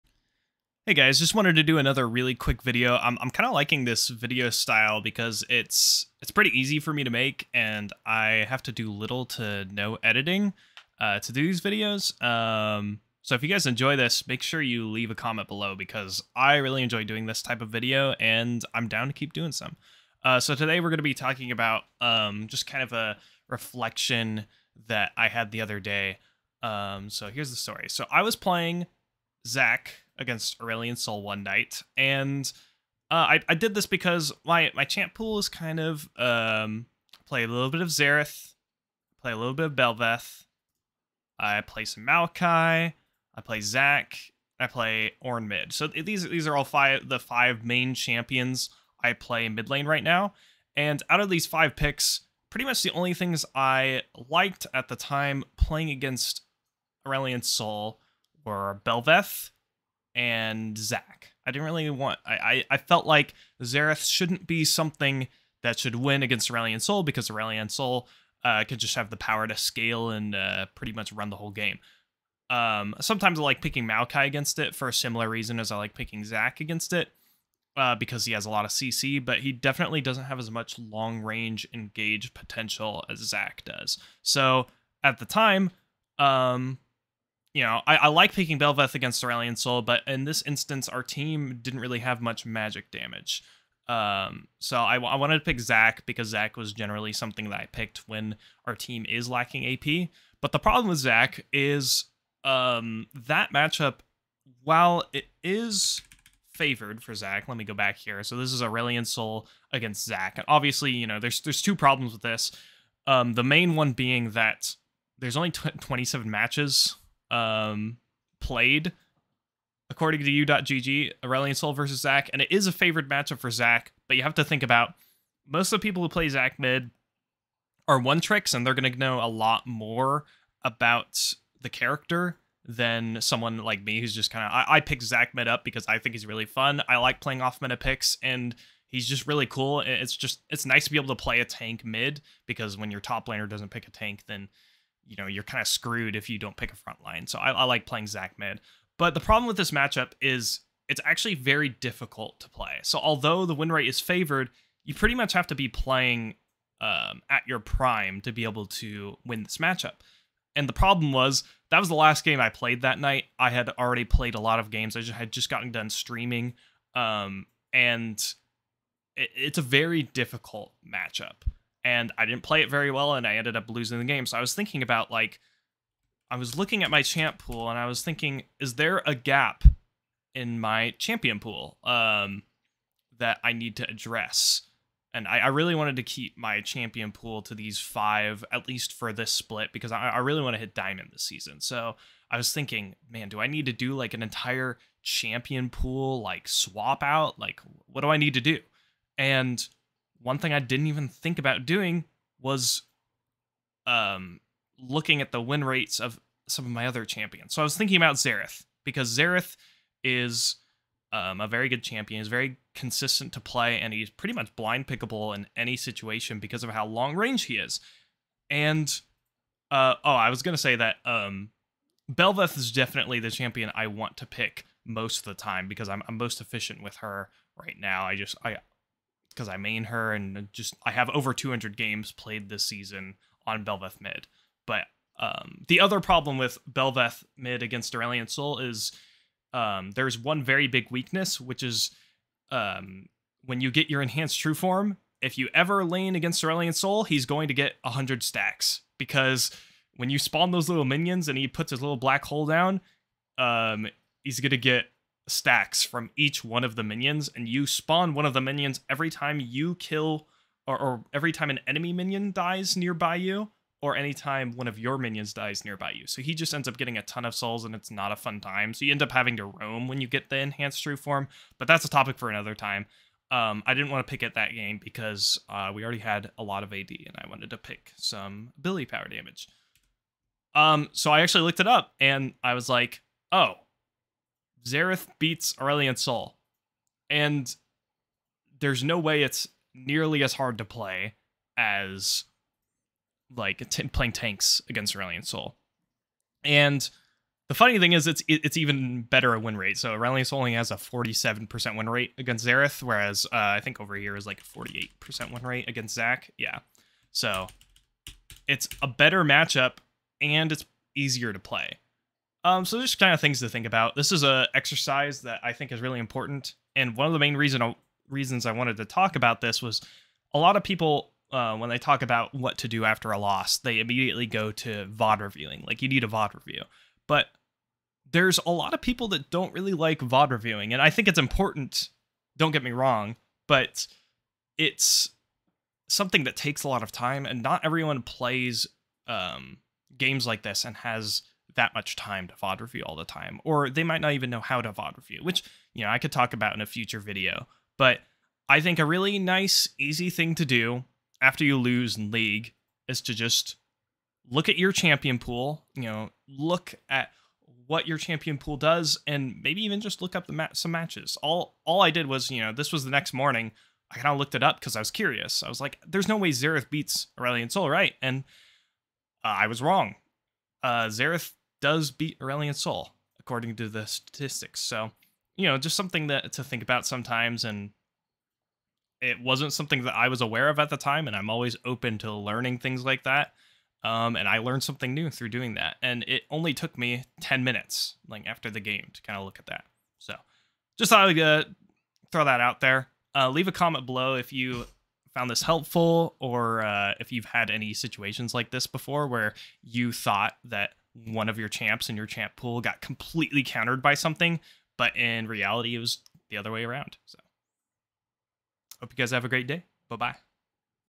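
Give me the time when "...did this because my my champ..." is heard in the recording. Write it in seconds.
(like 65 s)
33 s.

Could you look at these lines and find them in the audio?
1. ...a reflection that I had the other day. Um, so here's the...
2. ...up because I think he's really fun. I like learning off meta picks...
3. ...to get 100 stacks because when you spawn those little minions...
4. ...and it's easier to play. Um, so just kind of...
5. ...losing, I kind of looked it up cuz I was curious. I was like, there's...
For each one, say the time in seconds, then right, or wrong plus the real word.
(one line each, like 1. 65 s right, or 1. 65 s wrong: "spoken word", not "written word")
1. 22 s right
2. 135 s wrong: "playing", not "learning"
3. 247 s right
4. 310 s right
5. 363 s wrong: "morning", not "losing".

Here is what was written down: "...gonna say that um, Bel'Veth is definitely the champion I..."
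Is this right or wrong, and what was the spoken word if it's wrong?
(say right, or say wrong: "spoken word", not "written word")
right.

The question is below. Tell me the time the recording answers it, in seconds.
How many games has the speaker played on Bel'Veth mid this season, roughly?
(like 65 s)
231 s.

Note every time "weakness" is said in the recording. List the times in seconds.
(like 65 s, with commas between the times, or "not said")
240 s.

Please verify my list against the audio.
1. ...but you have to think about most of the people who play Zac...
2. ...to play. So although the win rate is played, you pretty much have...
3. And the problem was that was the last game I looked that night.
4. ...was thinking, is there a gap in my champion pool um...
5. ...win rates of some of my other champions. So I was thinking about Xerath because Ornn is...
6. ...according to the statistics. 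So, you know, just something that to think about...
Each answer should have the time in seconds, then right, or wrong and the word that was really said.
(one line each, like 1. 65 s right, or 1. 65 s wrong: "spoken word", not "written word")
1. 124 s right
2. 152 s wrong: "favored", not "played"
3. 160 s wrong: "played", not "looked"
4. 177 s right
5. 205 s wrong: "Xerath", not "Ornn"
6. 373 s right.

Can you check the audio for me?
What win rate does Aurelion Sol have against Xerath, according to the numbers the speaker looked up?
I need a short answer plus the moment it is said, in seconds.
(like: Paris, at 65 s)
47%, at 300 s.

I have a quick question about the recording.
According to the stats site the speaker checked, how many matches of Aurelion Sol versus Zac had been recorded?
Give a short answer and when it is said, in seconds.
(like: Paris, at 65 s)
27, at 115 s.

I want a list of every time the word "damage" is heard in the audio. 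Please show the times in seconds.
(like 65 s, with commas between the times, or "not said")
92 s, 279 s.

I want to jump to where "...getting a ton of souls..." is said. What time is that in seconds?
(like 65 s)
266 s.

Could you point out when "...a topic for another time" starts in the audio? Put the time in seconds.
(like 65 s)
271 s.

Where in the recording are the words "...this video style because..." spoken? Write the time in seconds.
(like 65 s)
3 s.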